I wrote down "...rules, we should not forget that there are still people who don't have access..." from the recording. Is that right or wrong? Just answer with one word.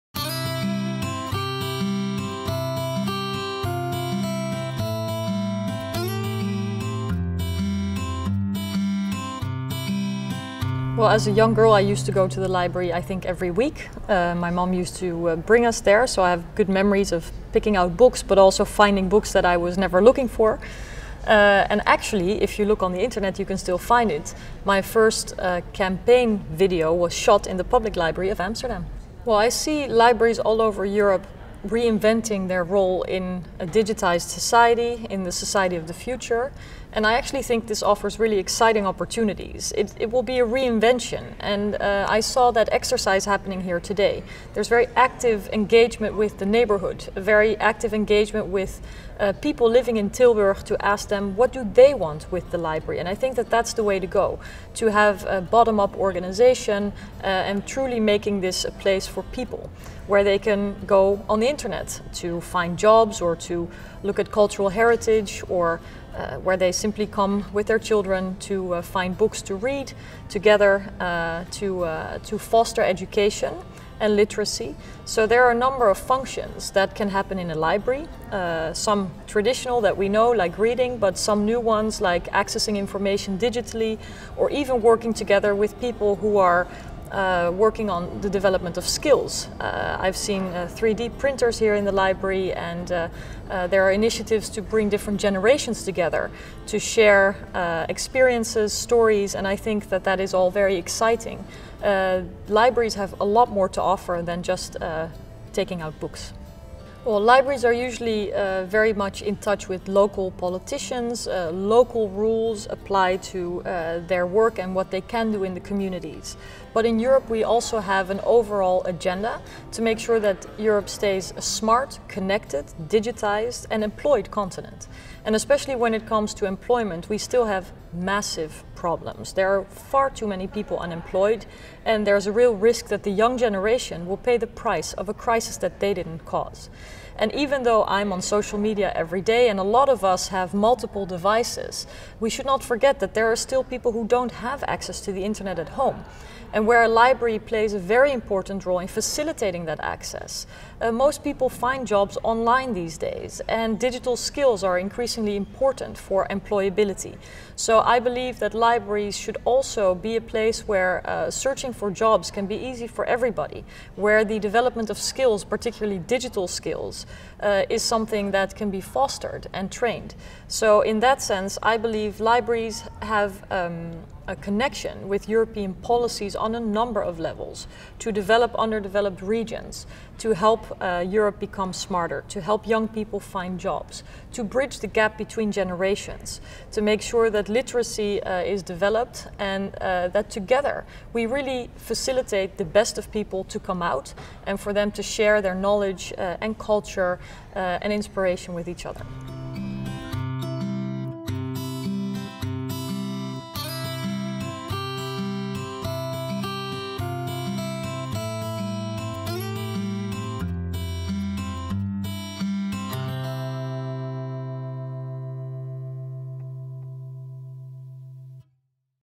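wrong.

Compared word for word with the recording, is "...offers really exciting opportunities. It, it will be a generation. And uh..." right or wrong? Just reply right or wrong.
wrong.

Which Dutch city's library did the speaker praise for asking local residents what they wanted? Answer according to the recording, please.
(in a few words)
Tilburg.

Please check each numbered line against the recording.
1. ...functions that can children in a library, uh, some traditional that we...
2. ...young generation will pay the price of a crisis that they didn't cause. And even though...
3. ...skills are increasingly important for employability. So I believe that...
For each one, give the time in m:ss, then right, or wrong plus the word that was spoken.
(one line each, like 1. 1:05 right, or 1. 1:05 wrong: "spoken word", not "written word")
1. 1:16 wrong: "happen", not "children"
2. 2:13 right
3. 2:34 right.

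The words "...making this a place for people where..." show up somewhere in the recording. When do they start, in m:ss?
0:58.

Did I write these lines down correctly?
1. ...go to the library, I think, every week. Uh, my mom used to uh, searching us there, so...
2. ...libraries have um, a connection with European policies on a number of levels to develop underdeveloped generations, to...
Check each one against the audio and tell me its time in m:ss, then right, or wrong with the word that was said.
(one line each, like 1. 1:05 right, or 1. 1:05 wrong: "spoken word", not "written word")
1. 0:12 wrong: "bring", not "searching"
2. 2:52 wrong: "regions", not "generations".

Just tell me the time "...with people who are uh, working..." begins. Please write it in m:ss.
1:25.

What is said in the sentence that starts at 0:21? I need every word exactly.
Uh, and actually, if you look on the internet, you can still find it.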